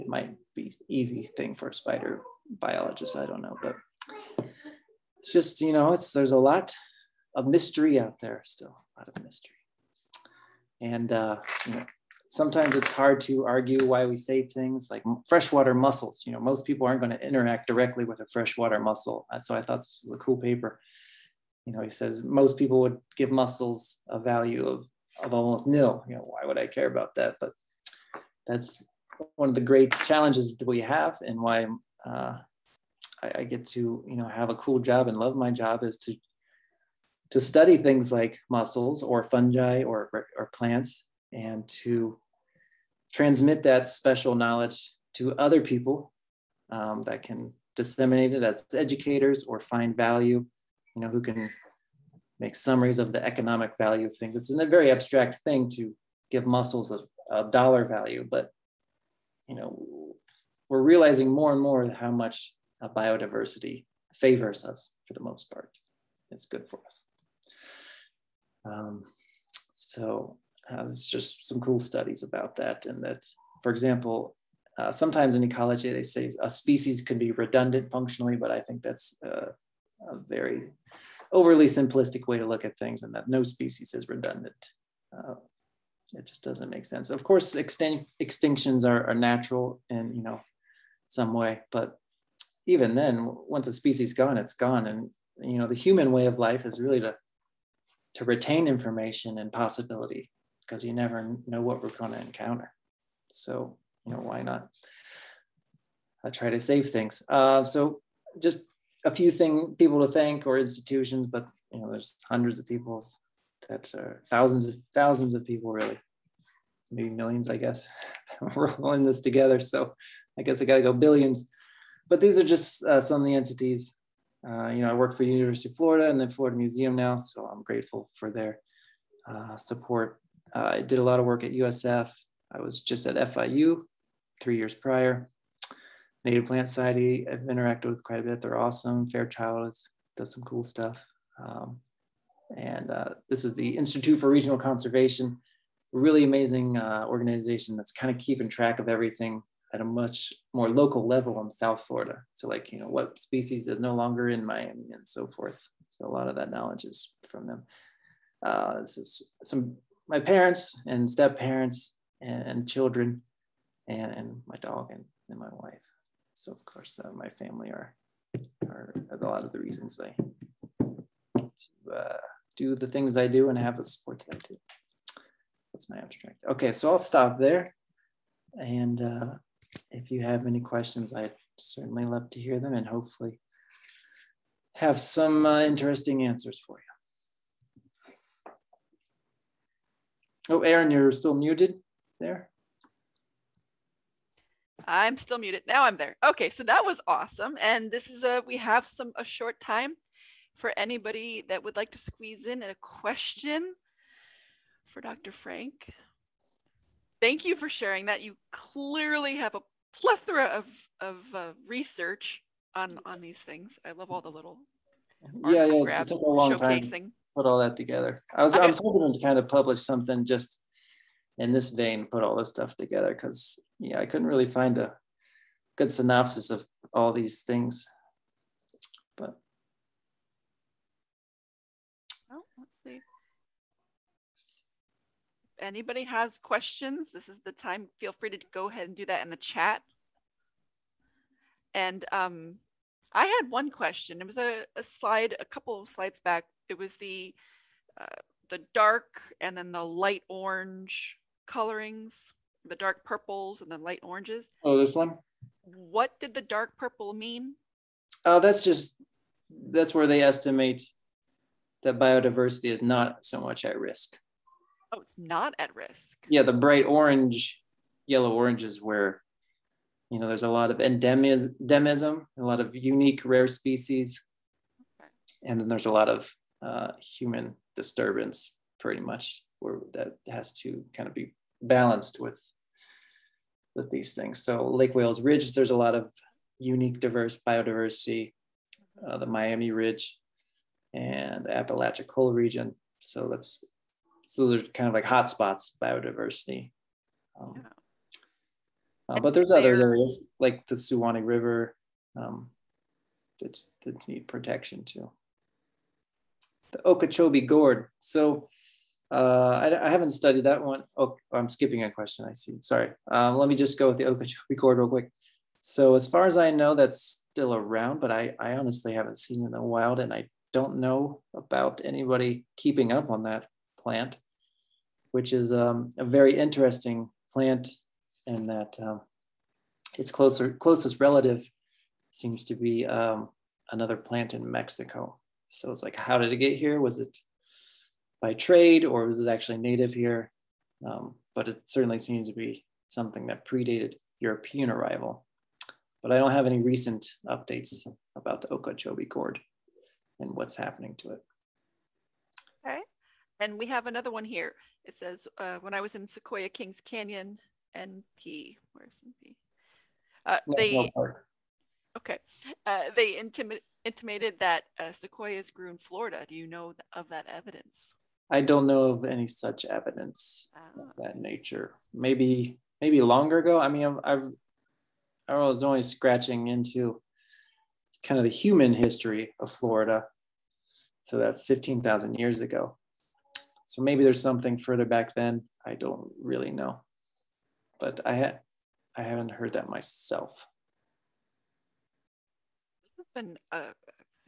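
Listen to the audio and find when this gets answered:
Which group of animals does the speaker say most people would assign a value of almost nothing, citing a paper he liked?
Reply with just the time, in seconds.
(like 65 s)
15 s.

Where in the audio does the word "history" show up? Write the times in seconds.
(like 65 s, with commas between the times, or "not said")
378 s.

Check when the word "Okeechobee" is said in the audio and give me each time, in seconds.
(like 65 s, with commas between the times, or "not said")
306 s, 314 s, 348 s.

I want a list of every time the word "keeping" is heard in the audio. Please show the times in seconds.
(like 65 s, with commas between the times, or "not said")
148 s, 322 s.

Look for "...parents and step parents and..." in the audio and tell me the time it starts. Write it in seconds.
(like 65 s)
160 s.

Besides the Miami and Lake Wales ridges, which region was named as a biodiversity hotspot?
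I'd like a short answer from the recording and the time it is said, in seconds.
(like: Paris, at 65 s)
Apalachicola, at 291 s.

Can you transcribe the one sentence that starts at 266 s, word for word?
Yeah, the bright orange, yellow orange is where, you know, there's a lot of endemism, a lot of unique rare species, okay.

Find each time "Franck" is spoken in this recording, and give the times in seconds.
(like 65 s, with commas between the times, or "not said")
205 s.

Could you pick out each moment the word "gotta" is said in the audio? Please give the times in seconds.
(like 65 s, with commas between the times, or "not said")
120 s.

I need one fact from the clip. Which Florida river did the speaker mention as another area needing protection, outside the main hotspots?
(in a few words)
Suwannee River.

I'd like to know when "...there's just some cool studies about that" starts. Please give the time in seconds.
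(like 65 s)
70 s.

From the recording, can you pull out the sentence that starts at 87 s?
Of course, extin- extinctions are, are natural in you know some way, but even then, once a species gone, it's gone.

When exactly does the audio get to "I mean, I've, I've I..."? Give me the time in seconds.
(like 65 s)
373 s.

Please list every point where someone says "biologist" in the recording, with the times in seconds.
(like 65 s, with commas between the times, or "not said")
2 s.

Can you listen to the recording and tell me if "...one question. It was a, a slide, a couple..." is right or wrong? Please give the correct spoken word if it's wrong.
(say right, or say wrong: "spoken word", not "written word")
right.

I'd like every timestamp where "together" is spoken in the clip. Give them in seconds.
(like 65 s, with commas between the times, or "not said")
119 s, 217 s, 222 s.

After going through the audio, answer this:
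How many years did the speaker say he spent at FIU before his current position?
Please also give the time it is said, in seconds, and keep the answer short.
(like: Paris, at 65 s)
3, at 134 s.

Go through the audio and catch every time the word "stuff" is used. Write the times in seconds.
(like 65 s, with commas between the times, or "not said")
140 s, 222 s.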